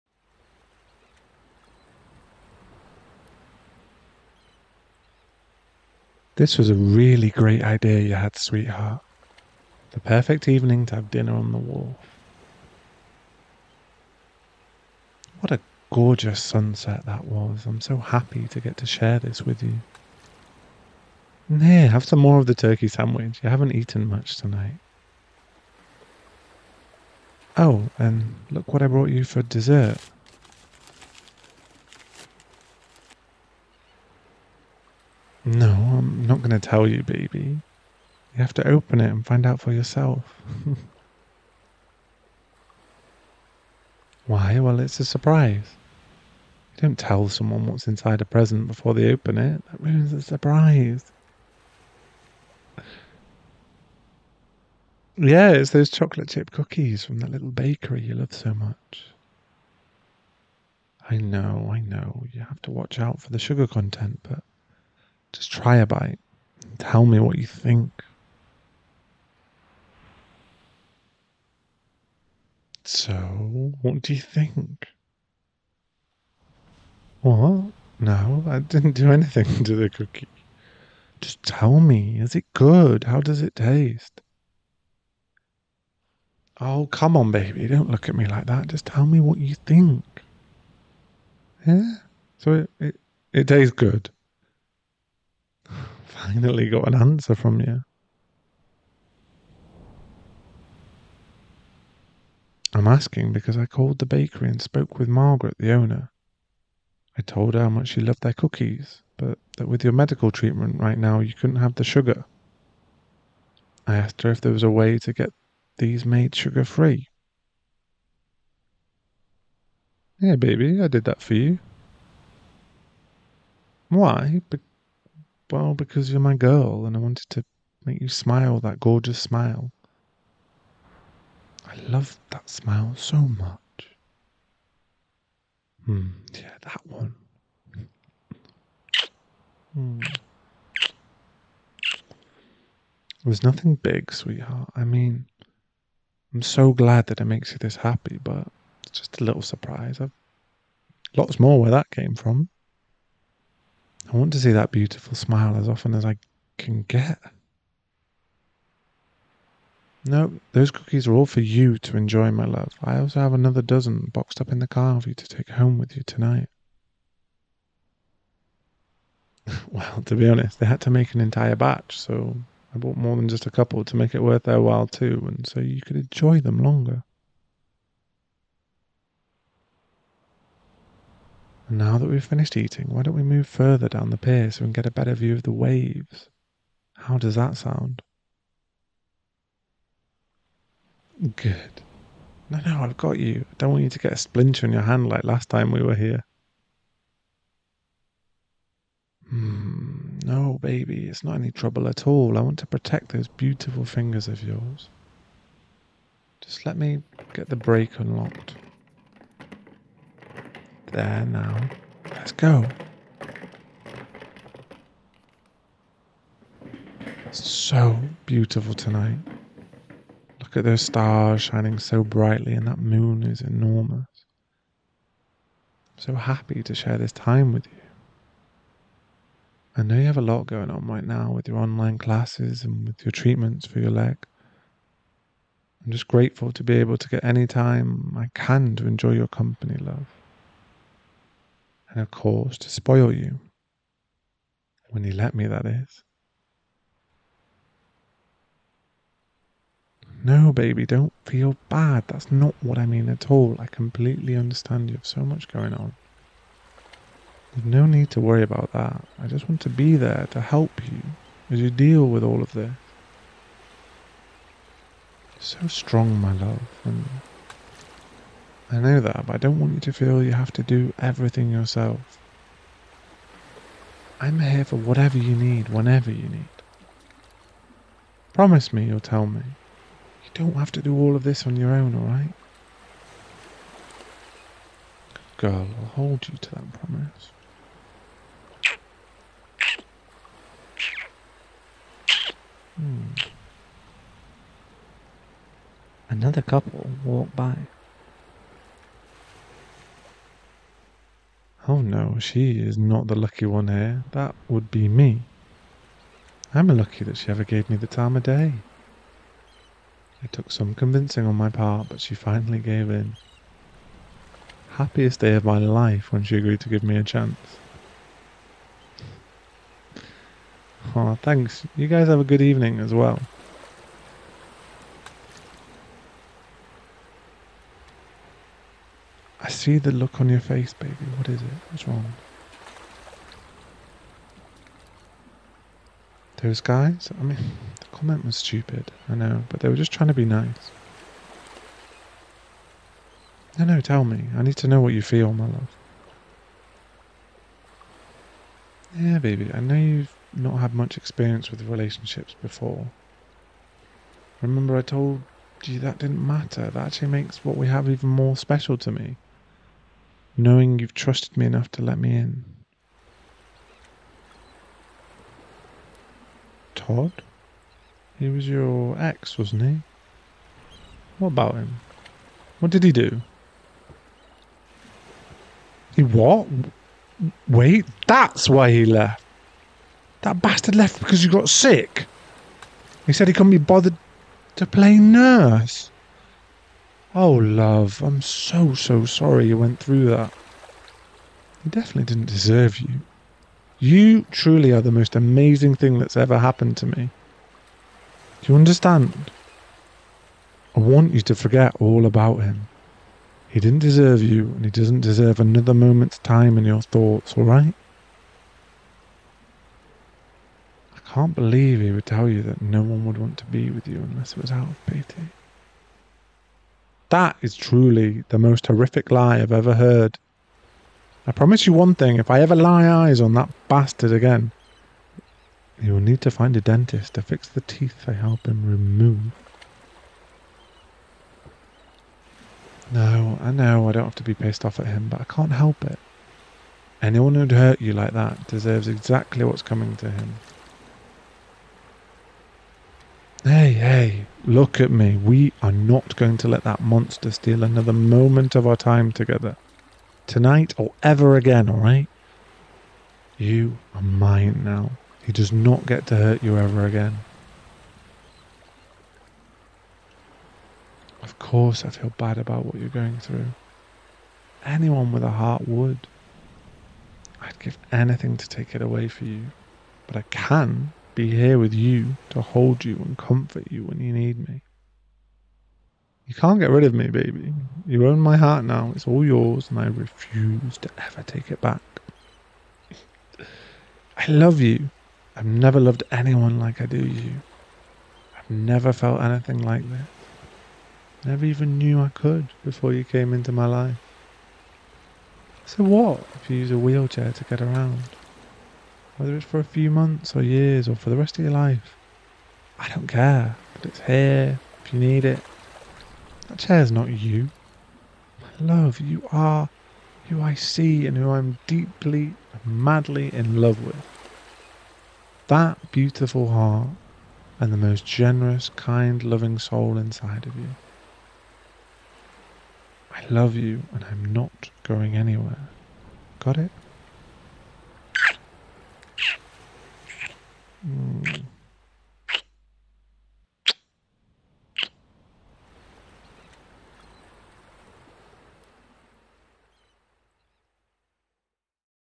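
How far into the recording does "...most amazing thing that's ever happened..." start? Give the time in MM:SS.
06:34.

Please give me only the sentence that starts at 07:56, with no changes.
You can't get rid of me, baby.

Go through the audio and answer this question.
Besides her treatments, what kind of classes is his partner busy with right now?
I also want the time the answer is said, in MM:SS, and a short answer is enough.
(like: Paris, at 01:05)
online classes, at 03:51.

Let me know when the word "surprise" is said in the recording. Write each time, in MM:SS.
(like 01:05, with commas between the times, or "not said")
00:45, 00:50, 02:29.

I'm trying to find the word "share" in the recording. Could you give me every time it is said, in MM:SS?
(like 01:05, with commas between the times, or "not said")
00:18, 03:46.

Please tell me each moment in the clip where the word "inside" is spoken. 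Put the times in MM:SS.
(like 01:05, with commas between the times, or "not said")
00:47, 08:39.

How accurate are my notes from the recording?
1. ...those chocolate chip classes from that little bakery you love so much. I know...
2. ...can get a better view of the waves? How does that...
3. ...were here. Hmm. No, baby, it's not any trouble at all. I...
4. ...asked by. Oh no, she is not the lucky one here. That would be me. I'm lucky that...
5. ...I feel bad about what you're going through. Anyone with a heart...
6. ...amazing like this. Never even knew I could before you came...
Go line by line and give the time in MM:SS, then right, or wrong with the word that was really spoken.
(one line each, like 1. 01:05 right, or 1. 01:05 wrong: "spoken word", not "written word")
1. 00:55 wrong: "cookies", not "classes"
2. 03:04 right
3. 03:15 right
4. 04:57 wrong: "walked", not "asked"
5. 07:41 right
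6. 08:09 wrong: "anything", not "amazing".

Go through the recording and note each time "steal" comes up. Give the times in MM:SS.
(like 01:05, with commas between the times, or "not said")
07:27.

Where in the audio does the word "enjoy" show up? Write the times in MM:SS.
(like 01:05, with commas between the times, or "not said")
02:41, 02:55, 03:58.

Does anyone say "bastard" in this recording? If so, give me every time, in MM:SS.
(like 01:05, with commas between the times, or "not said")
06:20, 07:03.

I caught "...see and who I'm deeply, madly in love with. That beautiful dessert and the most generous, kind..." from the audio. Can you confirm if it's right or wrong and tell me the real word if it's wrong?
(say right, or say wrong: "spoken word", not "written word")
wrong: "heart", not "dessert".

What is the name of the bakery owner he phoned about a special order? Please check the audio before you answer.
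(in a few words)
Margaret.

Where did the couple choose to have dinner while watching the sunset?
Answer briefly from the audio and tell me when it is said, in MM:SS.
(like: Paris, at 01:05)
wharf, at 00:11.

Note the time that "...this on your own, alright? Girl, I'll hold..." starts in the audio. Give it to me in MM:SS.
04:41.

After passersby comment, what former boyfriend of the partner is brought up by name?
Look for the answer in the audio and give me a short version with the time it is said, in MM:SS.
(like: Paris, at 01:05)
Todd, at 06:06.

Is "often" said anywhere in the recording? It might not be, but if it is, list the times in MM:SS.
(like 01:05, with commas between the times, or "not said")
02:35.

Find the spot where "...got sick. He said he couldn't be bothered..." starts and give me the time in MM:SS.
06:21.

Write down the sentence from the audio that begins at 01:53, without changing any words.
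I asked her if there was a way to get these made sugar free.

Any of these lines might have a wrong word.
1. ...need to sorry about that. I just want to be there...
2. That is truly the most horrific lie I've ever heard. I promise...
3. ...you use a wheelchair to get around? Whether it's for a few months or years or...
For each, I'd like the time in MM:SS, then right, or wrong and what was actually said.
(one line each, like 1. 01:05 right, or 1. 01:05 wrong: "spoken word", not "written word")
1. 04:17 wrong: "worry", not "sorry"
2. 06:57 right
3. 08:16 right.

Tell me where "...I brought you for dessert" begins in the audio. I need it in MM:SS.
00:28.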